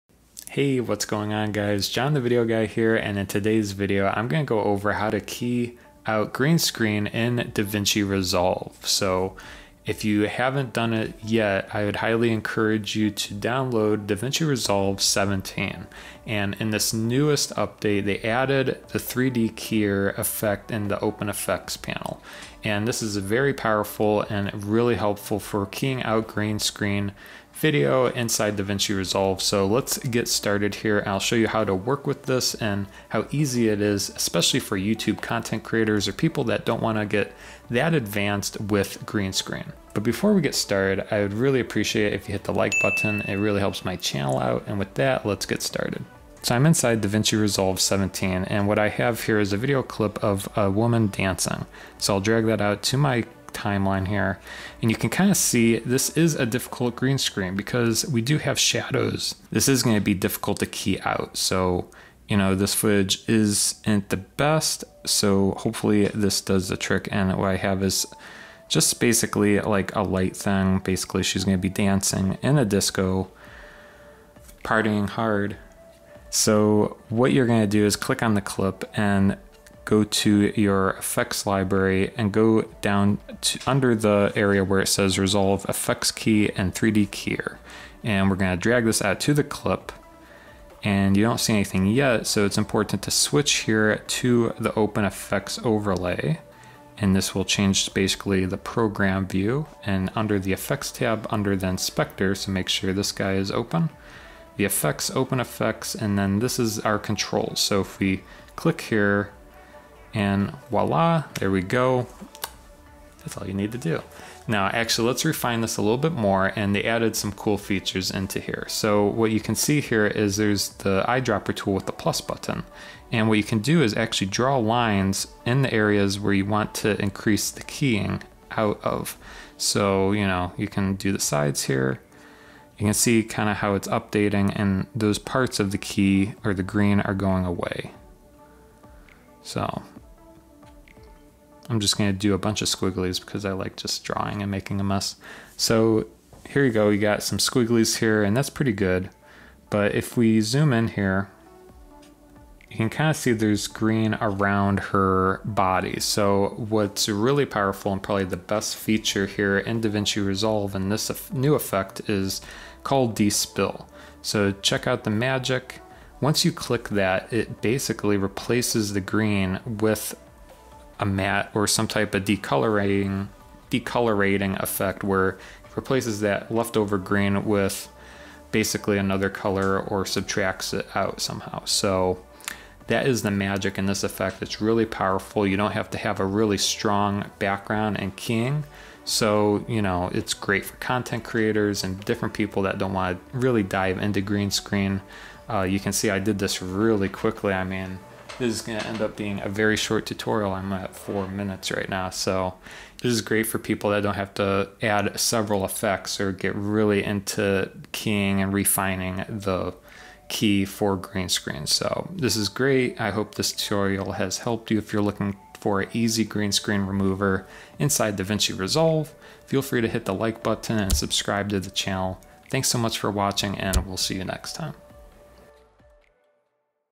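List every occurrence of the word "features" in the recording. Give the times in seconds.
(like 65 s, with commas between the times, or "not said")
117 s, 158 s.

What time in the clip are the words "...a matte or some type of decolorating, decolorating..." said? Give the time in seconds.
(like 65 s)
171 s.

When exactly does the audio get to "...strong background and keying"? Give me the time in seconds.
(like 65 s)
186 s.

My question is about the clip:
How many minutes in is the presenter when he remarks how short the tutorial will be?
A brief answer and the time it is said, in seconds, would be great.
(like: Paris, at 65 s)
4, at 200 s.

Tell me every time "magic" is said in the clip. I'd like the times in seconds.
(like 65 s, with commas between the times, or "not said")
165 s, 183 s.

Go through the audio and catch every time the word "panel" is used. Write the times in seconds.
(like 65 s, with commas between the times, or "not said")
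21 s.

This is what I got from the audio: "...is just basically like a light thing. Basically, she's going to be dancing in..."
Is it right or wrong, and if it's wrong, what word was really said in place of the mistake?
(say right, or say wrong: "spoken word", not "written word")
right.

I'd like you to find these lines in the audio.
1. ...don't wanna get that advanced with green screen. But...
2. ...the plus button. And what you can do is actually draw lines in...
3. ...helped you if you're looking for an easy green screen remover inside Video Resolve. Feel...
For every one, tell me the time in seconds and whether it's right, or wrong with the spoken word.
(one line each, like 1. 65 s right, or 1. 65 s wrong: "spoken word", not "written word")
1. 36 s right
2. 121 s right
3. 214 s wrong: "DaVinci", not "Video".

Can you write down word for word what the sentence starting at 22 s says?
And this is very powerful and really helpful for keying out green screen video inside DaVinci Resolve.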